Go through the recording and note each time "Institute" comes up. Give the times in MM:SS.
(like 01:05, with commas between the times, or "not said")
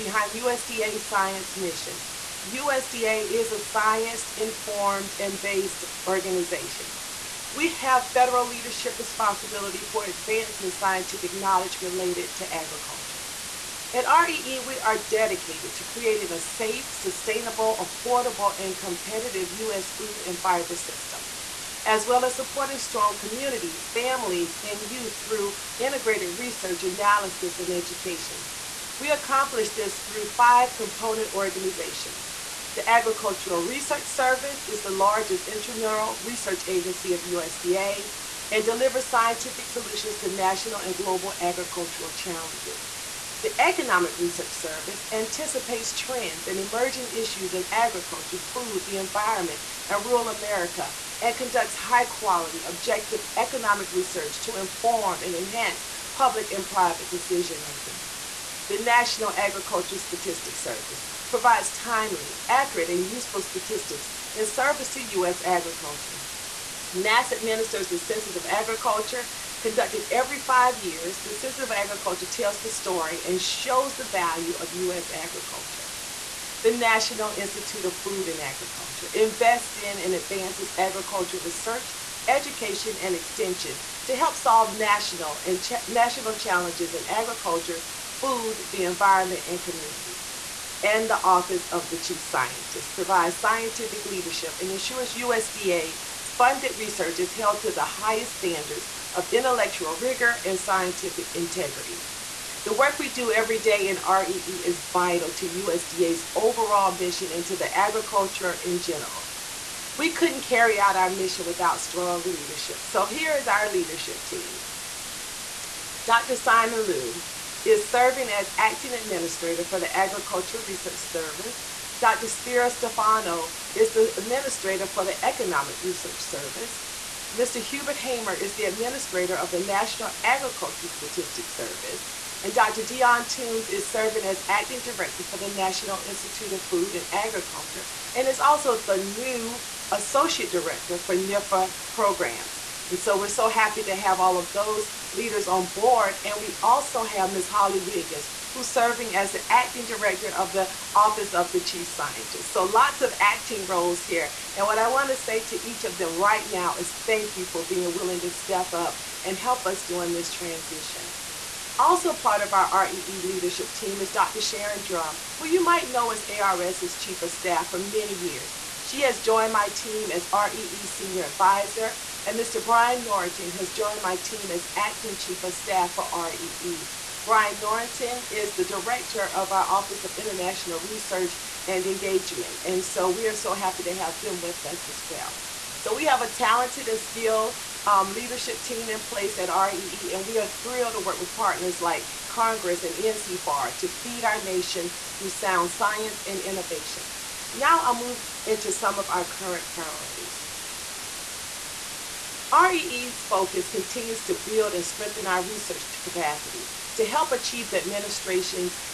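01:17, 02:16.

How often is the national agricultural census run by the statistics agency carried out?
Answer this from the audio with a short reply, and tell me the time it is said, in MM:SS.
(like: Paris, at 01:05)
Every 5 years, at 01:10.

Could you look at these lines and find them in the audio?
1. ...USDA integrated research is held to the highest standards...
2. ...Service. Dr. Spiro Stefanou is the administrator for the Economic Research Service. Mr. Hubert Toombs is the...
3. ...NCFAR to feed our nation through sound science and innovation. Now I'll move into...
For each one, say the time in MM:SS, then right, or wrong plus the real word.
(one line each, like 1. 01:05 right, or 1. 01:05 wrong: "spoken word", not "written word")
1. 01:35 wrong: "funded", not "integrated"
2. 02:00 wrong: "Hamer", not "Toombs"
3. 03:12 right.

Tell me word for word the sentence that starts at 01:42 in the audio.
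The work we do every day in REE is vital to USDA's overall mission and to the agriculture in general.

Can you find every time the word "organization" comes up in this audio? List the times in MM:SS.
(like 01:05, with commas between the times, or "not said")
00:06, 00:31.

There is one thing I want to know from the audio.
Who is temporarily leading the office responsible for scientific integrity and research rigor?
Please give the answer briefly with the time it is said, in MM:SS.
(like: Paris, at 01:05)
Ms. Holly Wiggins, at 02:27.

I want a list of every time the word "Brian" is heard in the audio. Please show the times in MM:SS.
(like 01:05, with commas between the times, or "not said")
02:52, 02:57.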